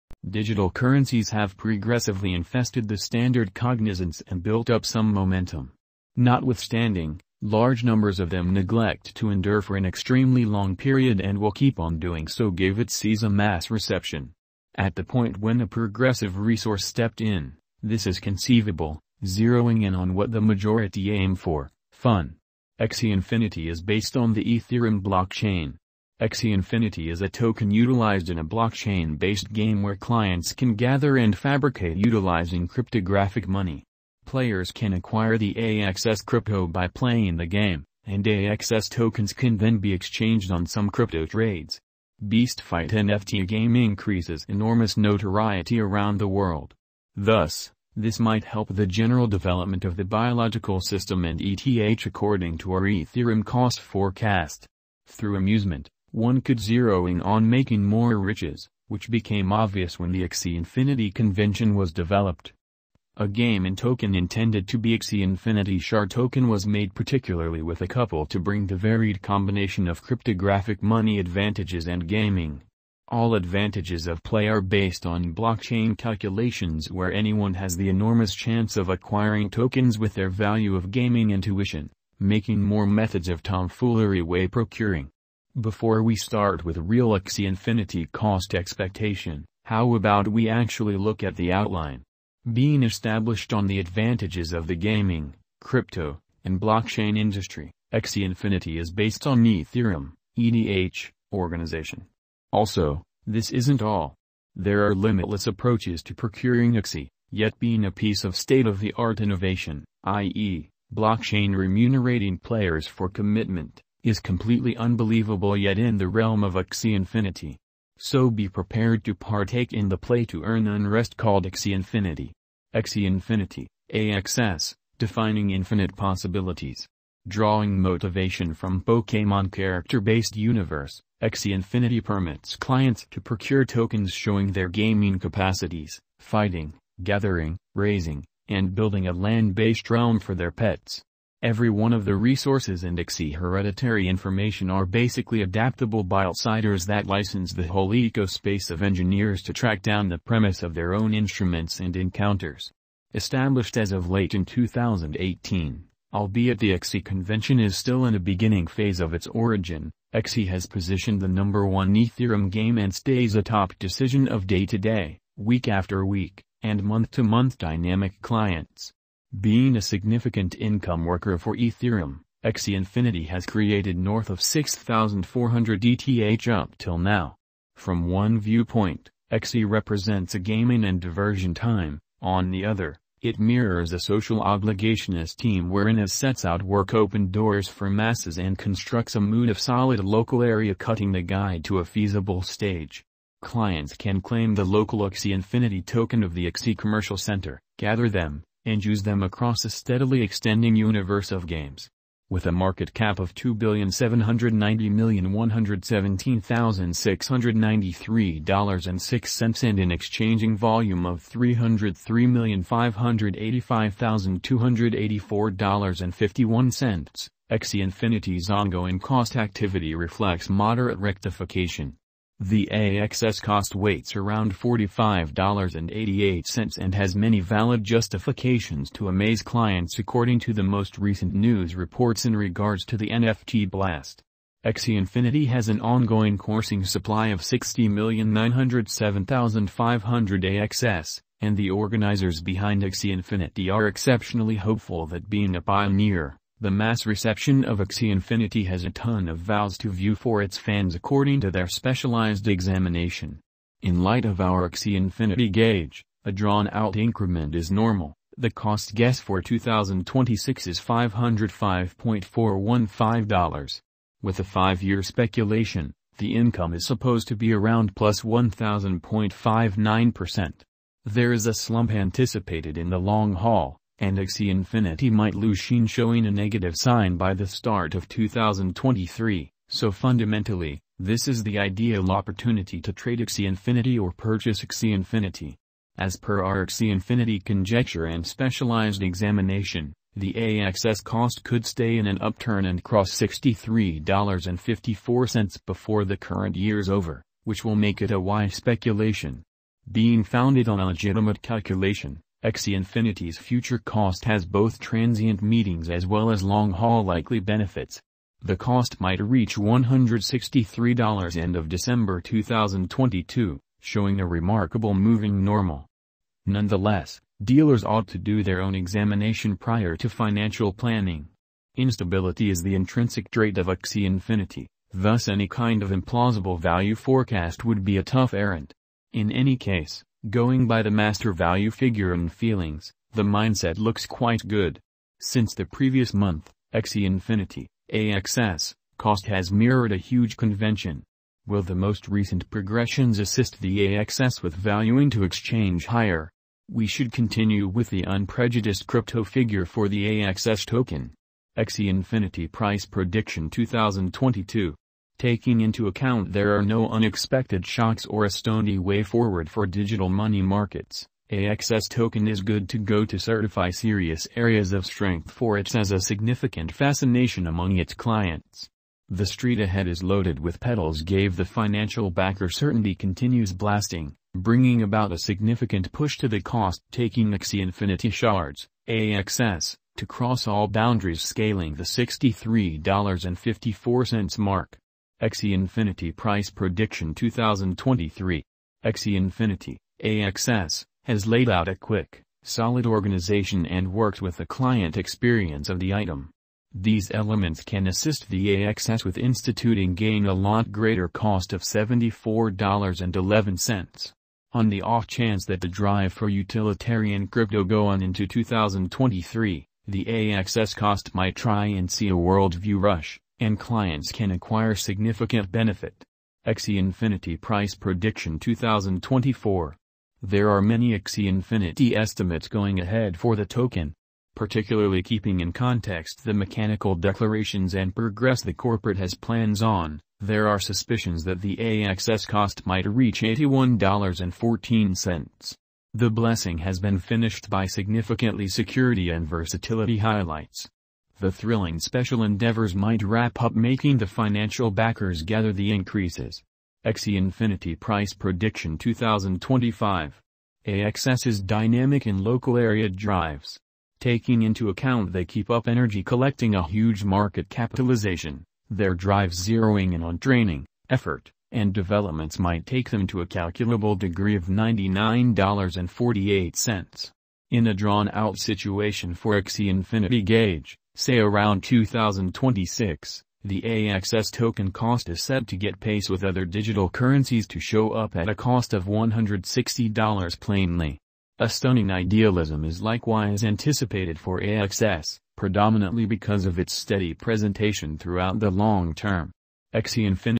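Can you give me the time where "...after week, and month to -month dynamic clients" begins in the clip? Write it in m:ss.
2:45.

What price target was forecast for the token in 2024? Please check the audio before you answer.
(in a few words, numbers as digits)
$81.14.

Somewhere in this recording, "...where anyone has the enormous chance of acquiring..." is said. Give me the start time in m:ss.
1:16.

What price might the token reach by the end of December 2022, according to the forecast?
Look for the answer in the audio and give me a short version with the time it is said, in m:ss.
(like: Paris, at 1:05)
$163, at 5:09.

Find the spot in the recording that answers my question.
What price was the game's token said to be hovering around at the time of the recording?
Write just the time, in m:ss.
3:44.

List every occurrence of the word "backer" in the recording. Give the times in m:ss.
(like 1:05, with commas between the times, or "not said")
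6:12, 7:24.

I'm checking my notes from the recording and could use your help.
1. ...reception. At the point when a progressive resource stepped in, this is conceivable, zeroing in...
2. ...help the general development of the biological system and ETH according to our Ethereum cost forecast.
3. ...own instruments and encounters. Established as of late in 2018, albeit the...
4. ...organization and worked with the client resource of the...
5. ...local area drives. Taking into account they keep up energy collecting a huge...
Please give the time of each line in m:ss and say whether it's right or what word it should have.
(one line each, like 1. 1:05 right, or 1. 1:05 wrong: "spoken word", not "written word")
1. 0:13 right
2. 0:48 right
3. 2:30 right
4. 6:32 wrong: "experience", not "resource"
5. 7:32 right.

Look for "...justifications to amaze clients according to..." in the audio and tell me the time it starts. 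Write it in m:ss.
3:47.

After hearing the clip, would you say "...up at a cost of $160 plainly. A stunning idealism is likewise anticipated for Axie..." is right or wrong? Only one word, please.
wrong.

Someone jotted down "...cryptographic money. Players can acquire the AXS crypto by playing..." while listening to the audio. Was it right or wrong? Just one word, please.
right.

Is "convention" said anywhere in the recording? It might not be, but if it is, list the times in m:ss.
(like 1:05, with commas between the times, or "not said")
1:01, 2:37, 5:40.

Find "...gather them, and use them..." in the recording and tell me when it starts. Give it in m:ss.
3:17.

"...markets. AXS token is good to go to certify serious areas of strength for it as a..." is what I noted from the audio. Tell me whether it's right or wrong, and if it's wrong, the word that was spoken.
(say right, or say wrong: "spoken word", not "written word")
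right.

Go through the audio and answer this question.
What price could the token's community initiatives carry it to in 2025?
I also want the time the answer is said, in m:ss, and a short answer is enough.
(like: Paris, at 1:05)
$99.48, at 7:44.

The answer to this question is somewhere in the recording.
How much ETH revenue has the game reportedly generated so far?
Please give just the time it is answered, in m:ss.
2:54.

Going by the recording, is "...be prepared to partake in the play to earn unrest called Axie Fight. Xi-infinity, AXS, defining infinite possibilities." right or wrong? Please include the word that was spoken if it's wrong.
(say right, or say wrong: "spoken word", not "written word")
wrong: "Infinity", not "Fight".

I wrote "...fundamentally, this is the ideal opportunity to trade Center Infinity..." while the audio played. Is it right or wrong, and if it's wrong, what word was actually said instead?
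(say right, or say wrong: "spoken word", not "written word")
wrong: "Axie", not "Center".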